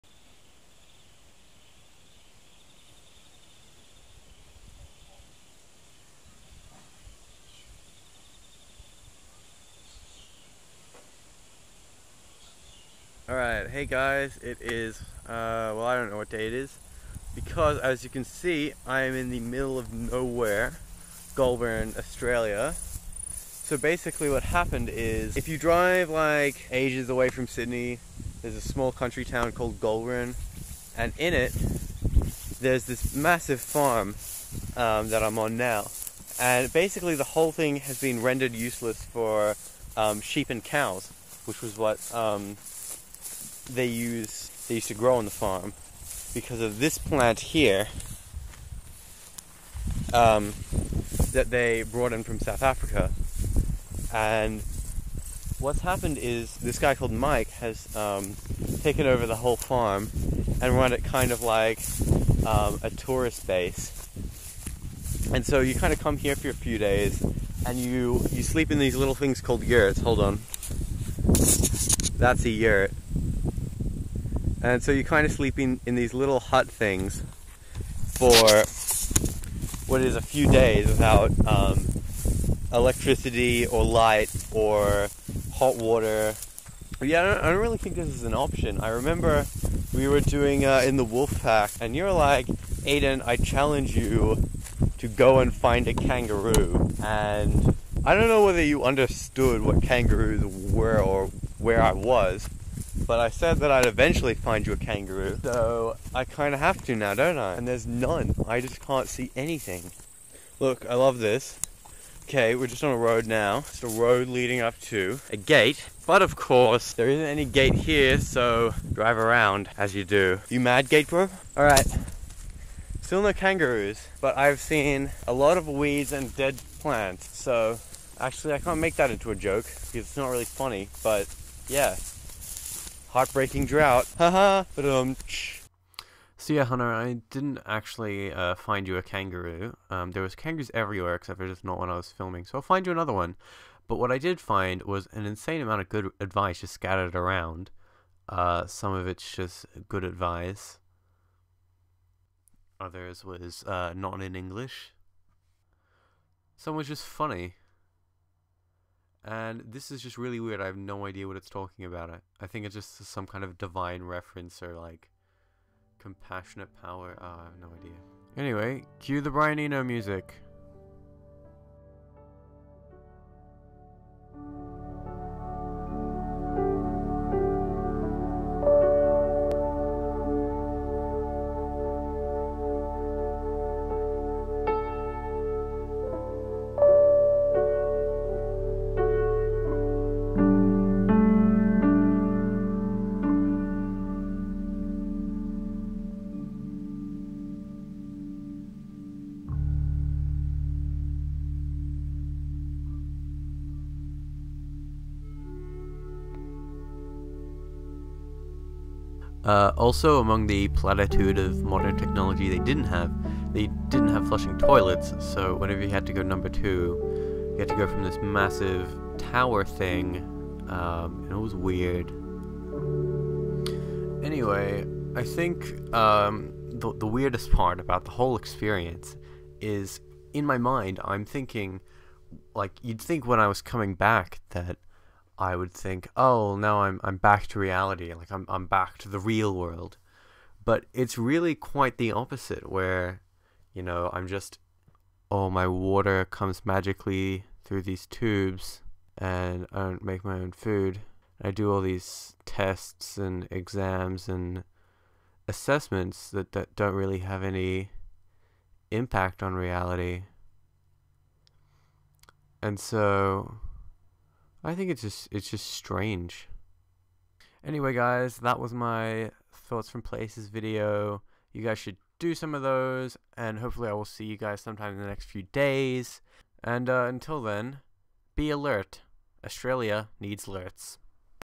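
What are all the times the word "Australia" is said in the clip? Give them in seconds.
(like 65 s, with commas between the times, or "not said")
21 s, 279 s.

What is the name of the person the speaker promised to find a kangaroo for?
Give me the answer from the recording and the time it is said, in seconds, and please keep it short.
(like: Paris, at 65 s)
Hunter, at 136 s.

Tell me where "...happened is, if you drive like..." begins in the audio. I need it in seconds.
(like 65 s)
24 s.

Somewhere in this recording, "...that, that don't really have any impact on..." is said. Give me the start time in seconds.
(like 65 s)
256 s.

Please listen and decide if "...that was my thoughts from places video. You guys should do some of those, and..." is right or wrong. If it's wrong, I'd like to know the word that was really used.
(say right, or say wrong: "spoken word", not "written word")
right.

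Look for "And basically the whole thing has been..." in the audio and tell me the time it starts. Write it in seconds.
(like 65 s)
36 s.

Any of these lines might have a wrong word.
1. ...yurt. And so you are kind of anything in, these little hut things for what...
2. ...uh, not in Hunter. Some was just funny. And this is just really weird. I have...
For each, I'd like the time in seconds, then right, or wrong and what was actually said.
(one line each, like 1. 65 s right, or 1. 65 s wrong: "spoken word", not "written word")
1. 72 s wrong: "sleeping", not "anything"
2. 153 s wrong: "English", not "Hunter".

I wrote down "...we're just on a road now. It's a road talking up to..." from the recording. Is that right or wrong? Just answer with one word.
wrong.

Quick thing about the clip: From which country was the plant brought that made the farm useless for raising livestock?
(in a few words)
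South Africa.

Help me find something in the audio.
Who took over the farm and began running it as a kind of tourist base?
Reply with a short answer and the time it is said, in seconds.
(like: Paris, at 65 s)
Mike, at 57 s.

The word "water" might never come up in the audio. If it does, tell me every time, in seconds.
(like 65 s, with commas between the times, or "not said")
85 s, 245 s.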